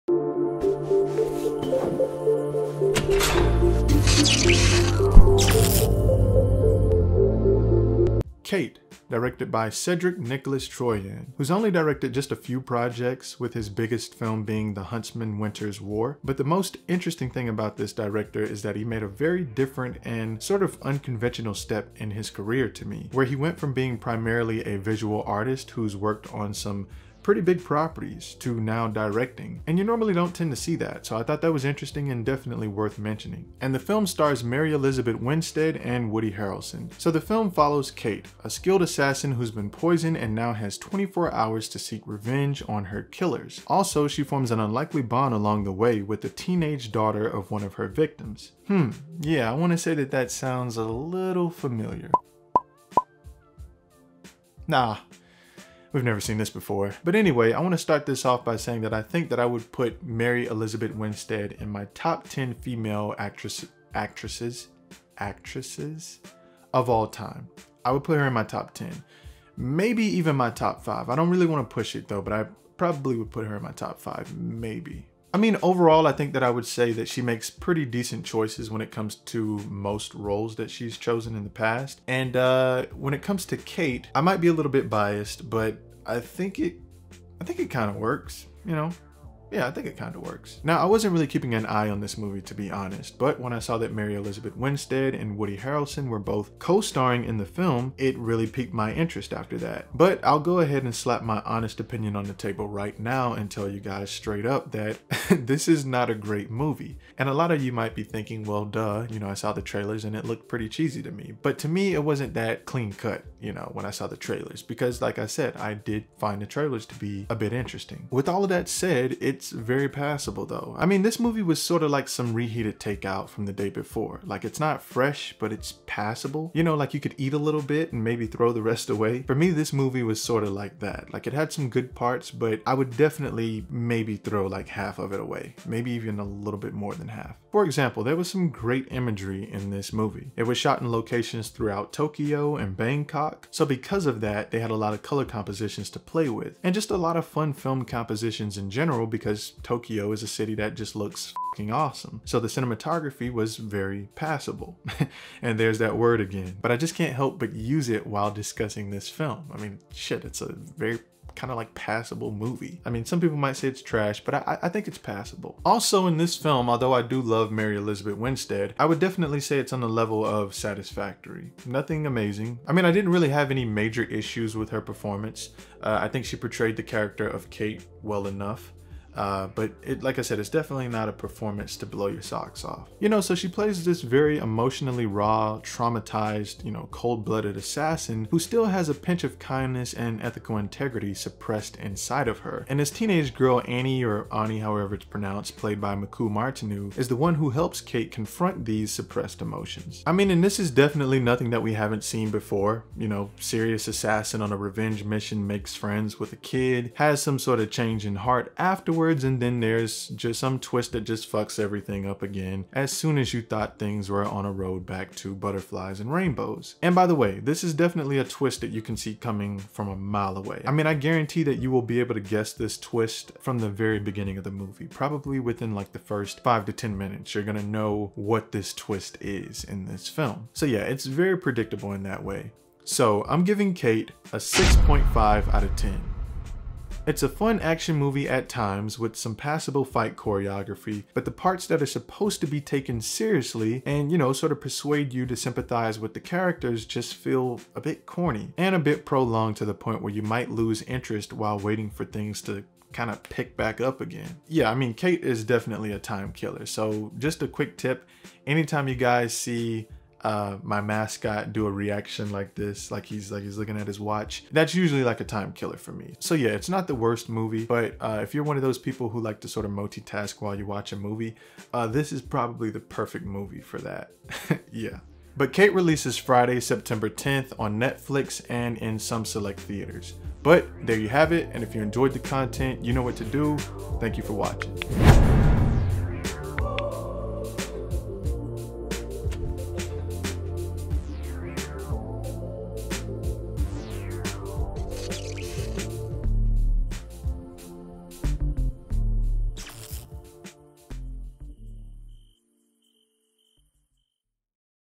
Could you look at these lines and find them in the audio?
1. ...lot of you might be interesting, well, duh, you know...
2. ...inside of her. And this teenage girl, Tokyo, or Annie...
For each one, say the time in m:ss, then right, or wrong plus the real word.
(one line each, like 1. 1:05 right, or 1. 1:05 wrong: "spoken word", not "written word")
1. 1:47 wrong: "thinking", not "interesting"
2. 3:11 wrong: "Annie", not "Tokyo".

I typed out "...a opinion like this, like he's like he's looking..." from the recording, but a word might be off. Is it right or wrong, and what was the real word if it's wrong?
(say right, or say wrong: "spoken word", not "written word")
wrong: "reaction", not "opinion".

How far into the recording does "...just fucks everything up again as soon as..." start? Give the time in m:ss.
3:31.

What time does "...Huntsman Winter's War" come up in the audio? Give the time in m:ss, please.
0:14.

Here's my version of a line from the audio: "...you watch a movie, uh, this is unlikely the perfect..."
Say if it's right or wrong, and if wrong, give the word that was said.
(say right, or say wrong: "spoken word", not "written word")
wrong: "probably", not "unlikely".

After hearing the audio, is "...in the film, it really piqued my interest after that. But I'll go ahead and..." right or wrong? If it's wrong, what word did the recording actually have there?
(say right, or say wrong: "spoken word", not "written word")
right.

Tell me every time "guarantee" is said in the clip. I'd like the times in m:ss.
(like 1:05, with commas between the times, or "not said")
3:40.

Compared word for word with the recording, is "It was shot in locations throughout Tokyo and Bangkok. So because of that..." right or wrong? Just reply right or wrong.
right.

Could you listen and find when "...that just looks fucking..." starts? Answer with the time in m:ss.
2:30.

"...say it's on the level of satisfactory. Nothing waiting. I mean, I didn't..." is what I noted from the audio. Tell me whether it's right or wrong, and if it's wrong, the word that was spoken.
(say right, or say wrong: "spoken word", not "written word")
wrong: "amazing", not "waiting".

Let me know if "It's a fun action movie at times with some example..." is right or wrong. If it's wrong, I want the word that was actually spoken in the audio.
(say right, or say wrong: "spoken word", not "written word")
wrong: "passable", not "example".